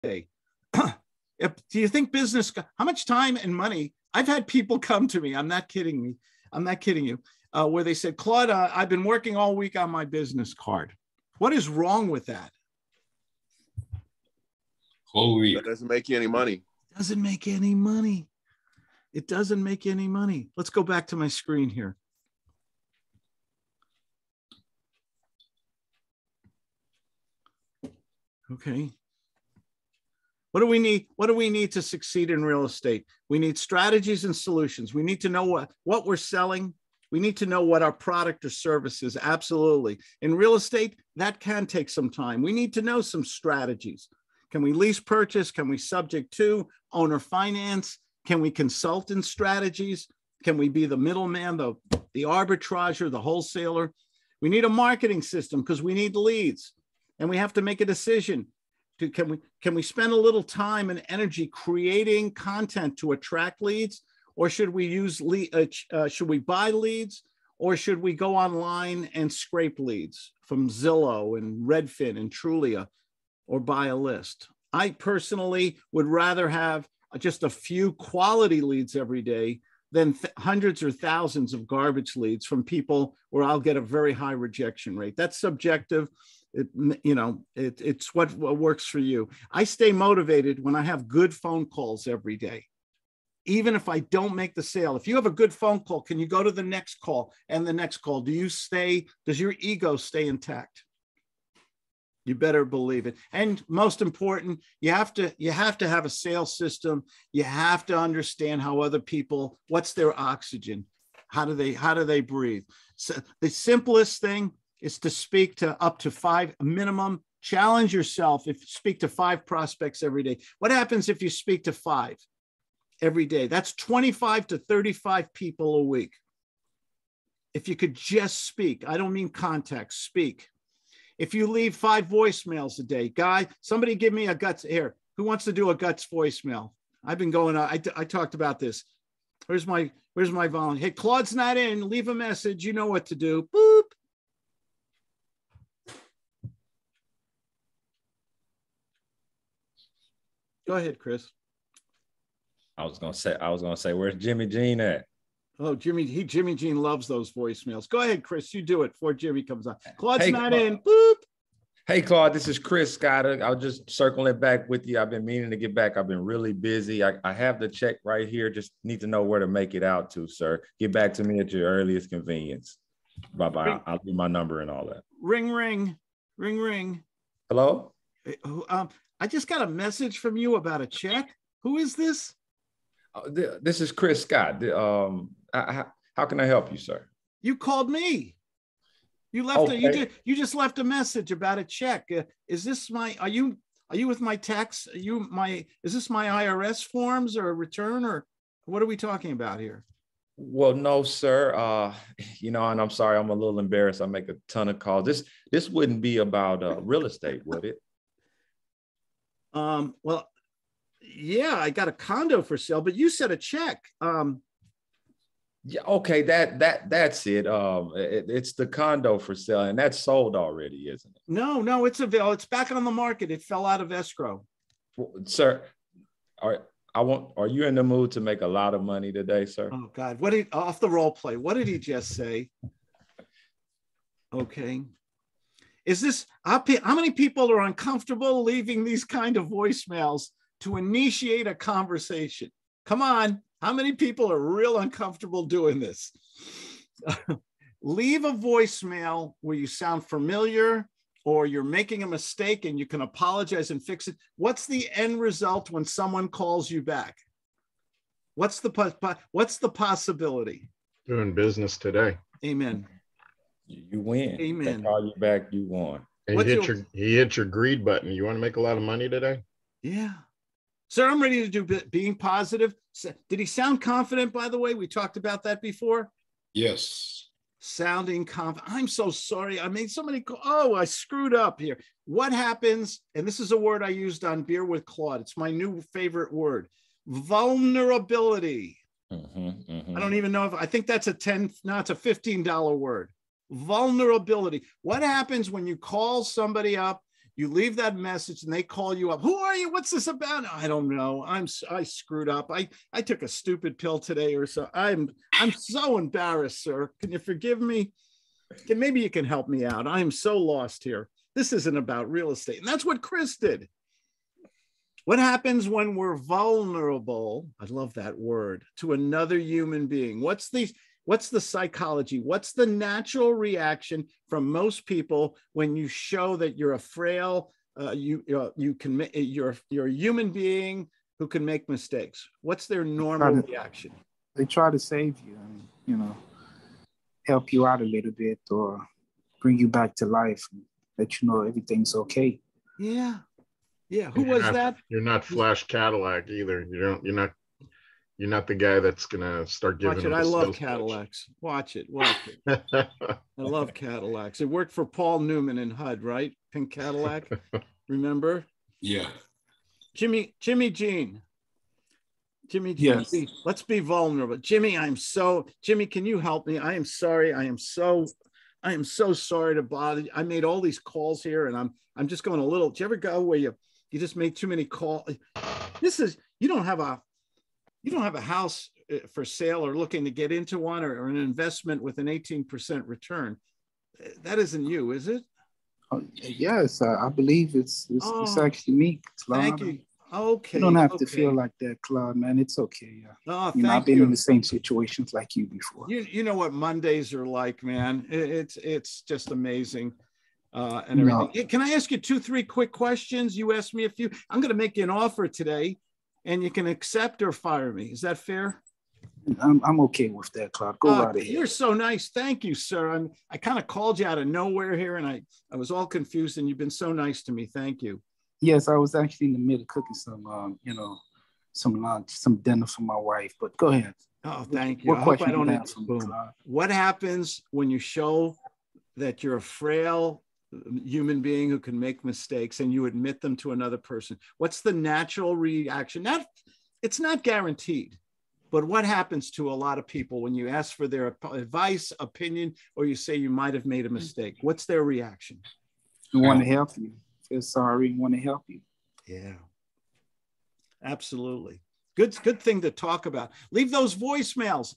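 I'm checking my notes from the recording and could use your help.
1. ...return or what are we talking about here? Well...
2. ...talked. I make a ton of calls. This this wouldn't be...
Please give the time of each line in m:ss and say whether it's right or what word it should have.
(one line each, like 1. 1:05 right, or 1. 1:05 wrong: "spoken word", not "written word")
1. 3:17 right
2. 3:23 wrong: "embarrassed", not "talked".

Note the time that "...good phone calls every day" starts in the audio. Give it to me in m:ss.
1:31.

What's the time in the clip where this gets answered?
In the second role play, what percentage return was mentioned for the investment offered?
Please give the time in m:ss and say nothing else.
6:22.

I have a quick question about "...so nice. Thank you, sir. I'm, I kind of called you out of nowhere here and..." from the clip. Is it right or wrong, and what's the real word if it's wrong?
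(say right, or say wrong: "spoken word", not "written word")
right.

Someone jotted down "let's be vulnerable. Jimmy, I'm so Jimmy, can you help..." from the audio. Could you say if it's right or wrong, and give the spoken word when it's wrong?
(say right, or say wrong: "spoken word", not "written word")
right.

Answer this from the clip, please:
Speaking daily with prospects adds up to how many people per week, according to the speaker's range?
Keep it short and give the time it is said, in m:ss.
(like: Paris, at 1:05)
25 to 35, at 2:03.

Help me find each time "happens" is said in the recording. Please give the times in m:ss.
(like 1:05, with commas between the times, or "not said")
2:00, 4:42, 4:55, 5:15, 7:06, 7:18.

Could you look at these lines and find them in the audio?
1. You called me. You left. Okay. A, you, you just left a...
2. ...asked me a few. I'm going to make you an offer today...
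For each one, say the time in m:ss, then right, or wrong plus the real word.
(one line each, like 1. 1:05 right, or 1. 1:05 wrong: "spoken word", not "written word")
1. 3:07 right
2. 6:43 right.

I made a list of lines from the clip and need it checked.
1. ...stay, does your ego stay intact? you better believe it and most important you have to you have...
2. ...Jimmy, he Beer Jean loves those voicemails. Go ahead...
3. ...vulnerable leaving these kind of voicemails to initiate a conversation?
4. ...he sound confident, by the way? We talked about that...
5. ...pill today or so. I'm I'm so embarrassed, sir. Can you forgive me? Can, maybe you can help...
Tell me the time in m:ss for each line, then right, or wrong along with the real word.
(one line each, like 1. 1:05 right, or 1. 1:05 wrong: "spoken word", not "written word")
1. 1:38 right
2. 2:35 wrong: "Jimmy", not "Beer"
3. 3:57 wrong: "uncomfortable", not "vulnerable"
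4. 4:33 right
5. 5:03 right.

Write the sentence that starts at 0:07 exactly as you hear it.
Uh, where they said, Claude, uh, I've been working all week on my business card.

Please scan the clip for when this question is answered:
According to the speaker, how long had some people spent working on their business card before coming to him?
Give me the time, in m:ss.
0:15.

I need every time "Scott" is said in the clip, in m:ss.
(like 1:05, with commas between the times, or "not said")
2:42, 3:04.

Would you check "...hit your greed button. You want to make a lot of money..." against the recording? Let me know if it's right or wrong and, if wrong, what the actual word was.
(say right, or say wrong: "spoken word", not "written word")
right.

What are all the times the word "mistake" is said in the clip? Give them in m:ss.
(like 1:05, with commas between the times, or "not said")
4:12, 5:31, 7:12, 7:23.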